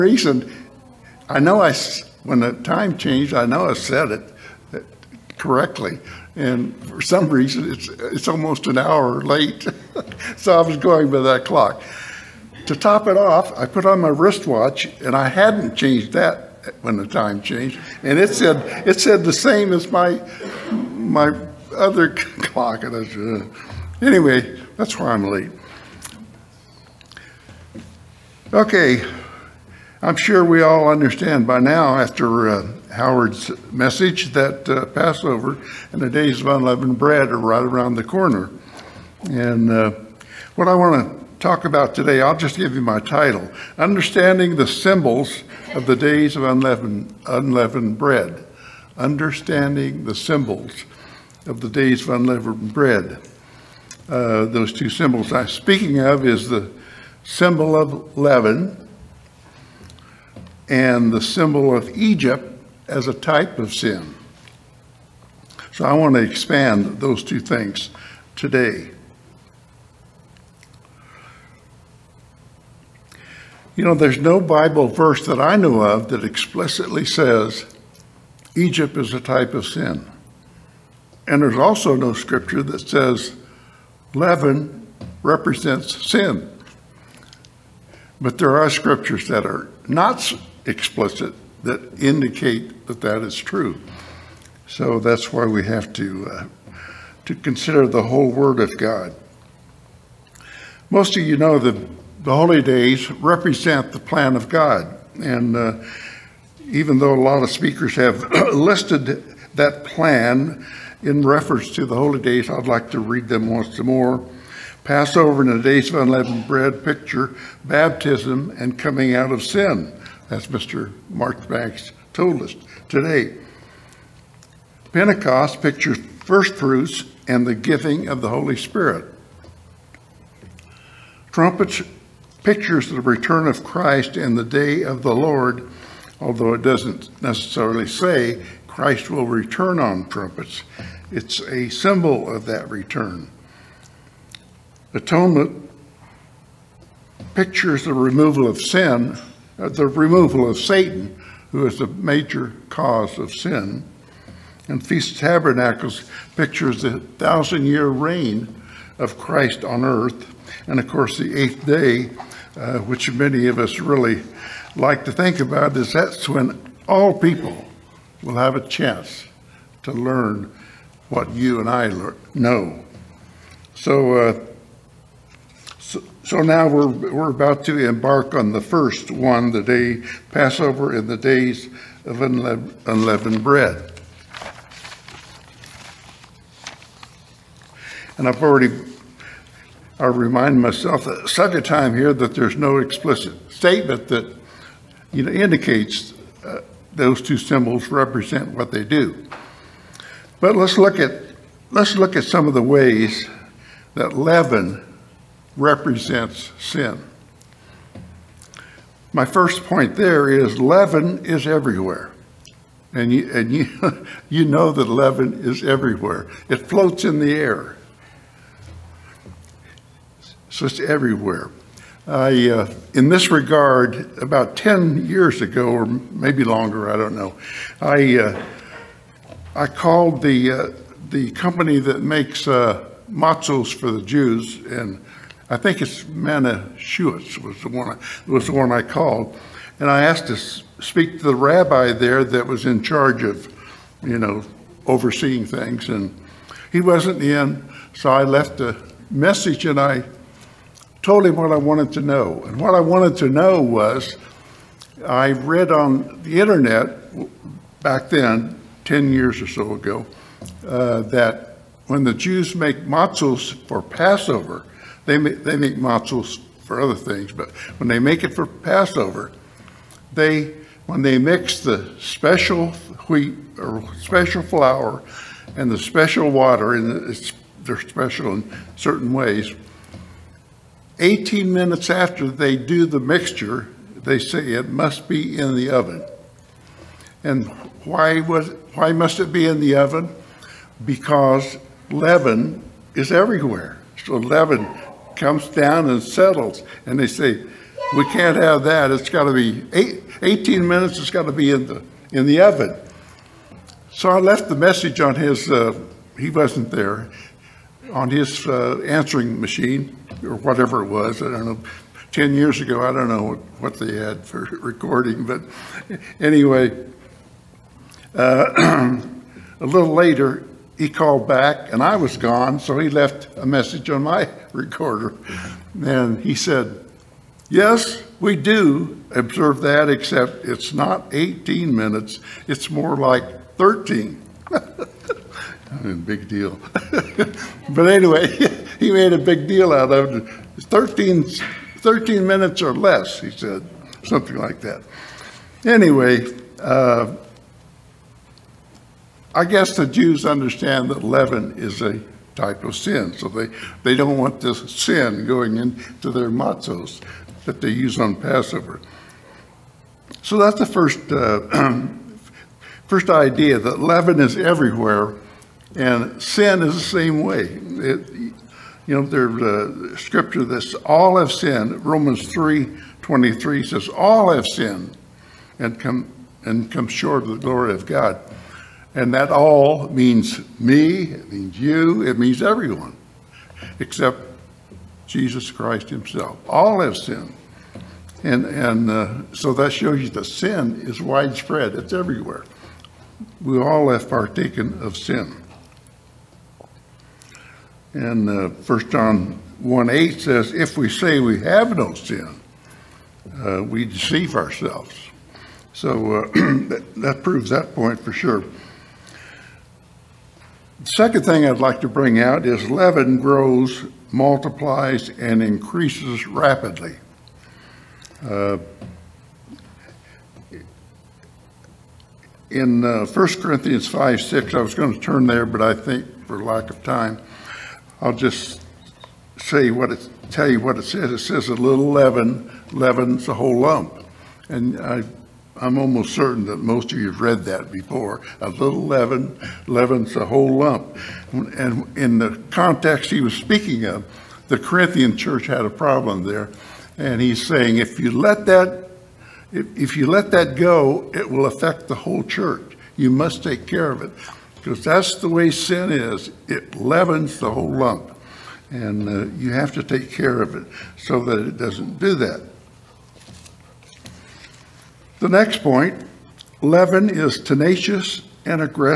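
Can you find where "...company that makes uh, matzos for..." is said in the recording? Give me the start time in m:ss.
3:51.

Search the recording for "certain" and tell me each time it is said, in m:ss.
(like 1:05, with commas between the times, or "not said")
4:38, 7:16.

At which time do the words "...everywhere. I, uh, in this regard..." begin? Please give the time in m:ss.
3:40.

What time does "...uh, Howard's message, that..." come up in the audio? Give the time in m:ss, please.
0:32.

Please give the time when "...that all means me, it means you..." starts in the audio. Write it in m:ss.
6:19.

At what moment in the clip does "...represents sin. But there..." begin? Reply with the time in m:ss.
1:25.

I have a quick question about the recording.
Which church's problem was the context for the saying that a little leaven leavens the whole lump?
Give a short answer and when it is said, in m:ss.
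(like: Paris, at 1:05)
Corinthian church, at 7:24.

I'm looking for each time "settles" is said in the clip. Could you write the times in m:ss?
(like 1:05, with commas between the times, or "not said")
4:56.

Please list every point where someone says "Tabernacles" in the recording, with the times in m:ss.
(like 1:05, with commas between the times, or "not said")
2:35.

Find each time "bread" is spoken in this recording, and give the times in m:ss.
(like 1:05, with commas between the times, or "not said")
0:36, 0:47, 0:52, 1:56, 3:03.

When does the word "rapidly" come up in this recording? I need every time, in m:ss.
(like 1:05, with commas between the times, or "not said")
6:56.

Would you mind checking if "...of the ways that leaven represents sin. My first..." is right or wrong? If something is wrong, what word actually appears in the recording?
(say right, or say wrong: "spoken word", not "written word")
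right.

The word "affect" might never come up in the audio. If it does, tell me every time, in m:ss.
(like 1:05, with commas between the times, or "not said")
7:31.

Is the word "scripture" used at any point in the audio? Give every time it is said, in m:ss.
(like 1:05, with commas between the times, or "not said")
1:22, 1:28, 6:09.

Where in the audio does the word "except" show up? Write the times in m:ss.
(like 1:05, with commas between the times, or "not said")
5:29, 6:23.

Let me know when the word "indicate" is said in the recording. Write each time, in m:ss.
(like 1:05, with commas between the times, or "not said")
1:32, 3:15.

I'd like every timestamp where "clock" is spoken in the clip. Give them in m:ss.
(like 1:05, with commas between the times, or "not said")
0:11, 0:22.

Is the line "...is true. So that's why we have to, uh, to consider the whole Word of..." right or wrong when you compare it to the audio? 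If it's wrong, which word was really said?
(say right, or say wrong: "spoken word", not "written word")
right.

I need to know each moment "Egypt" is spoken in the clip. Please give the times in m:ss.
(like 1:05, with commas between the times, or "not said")
1:01, 1:18.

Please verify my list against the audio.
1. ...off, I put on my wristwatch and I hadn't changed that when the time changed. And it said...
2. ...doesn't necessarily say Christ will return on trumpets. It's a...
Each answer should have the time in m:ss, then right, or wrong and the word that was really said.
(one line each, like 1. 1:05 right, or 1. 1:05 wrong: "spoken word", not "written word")
1. 0:13 right
2. 2:16 right.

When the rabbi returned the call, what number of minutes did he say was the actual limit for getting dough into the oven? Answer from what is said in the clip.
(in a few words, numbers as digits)
13.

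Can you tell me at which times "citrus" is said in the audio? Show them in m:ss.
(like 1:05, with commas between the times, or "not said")
not said.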